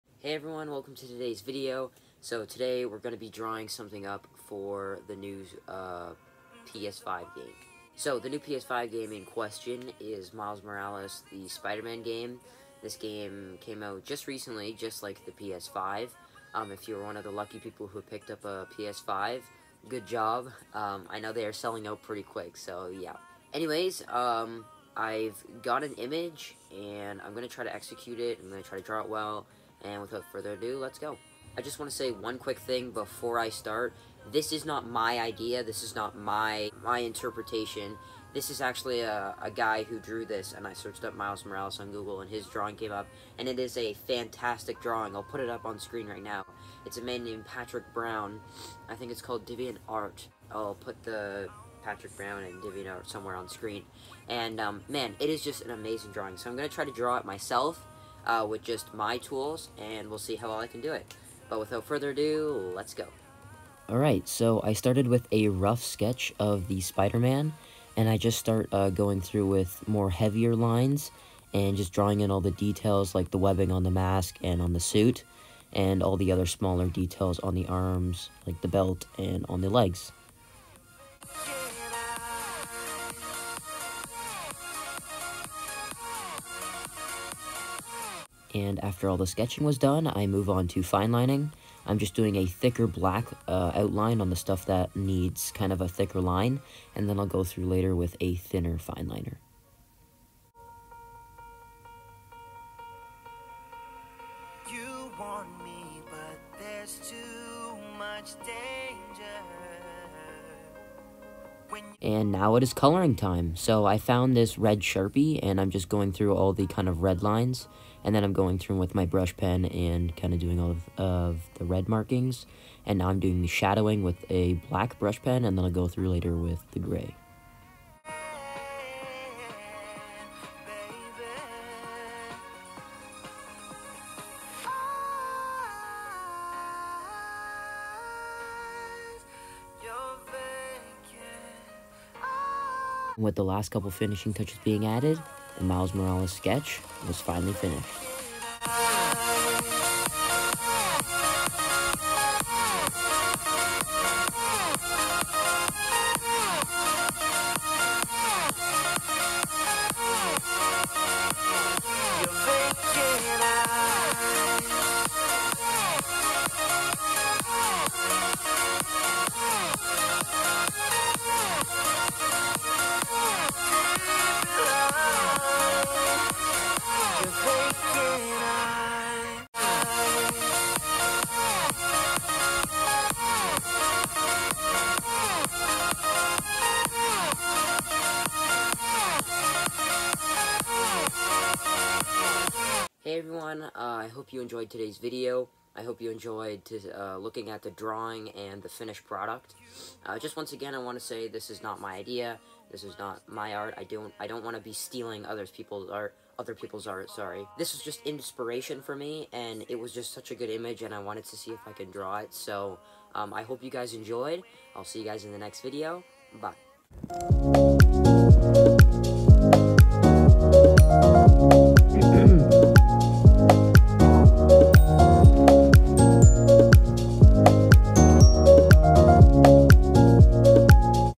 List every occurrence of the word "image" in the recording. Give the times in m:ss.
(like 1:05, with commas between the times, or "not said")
0:25, 3:30.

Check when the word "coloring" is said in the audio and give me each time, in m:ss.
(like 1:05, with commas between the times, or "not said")
1:52.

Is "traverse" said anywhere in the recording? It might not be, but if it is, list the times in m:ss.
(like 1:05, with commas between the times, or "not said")
not said.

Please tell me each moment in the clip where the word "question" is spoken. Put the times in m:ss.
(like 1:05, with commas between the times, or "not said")
0:09.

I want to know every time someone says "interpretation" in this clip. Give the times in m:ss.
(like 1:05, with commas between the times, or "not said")
0:36.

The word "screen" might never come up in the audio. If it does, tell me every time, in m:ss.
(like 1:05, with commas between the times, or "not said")
0:45, 0:53.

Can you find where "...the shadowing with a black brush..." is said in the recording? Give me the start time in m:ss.
2:03.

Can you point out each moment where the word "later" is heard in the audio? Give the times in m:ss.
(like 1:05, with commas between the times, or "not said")
1:37, 2:06.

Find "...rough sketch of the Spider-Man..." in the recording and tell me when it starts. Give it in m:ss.
1:05.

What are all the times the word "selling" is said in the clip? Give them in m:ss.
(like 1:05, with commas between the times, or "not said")
0:21.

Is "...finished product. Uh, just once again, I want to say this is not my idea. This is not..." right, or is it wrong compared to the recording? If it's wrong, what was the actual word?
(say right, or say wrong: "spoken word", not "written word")
right.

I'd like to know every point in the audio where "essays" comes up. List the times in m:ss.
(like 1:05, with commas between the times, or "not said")
not said.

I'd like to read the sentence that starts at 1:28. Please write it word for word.
And after all the sketching was done, I move on to fine lining.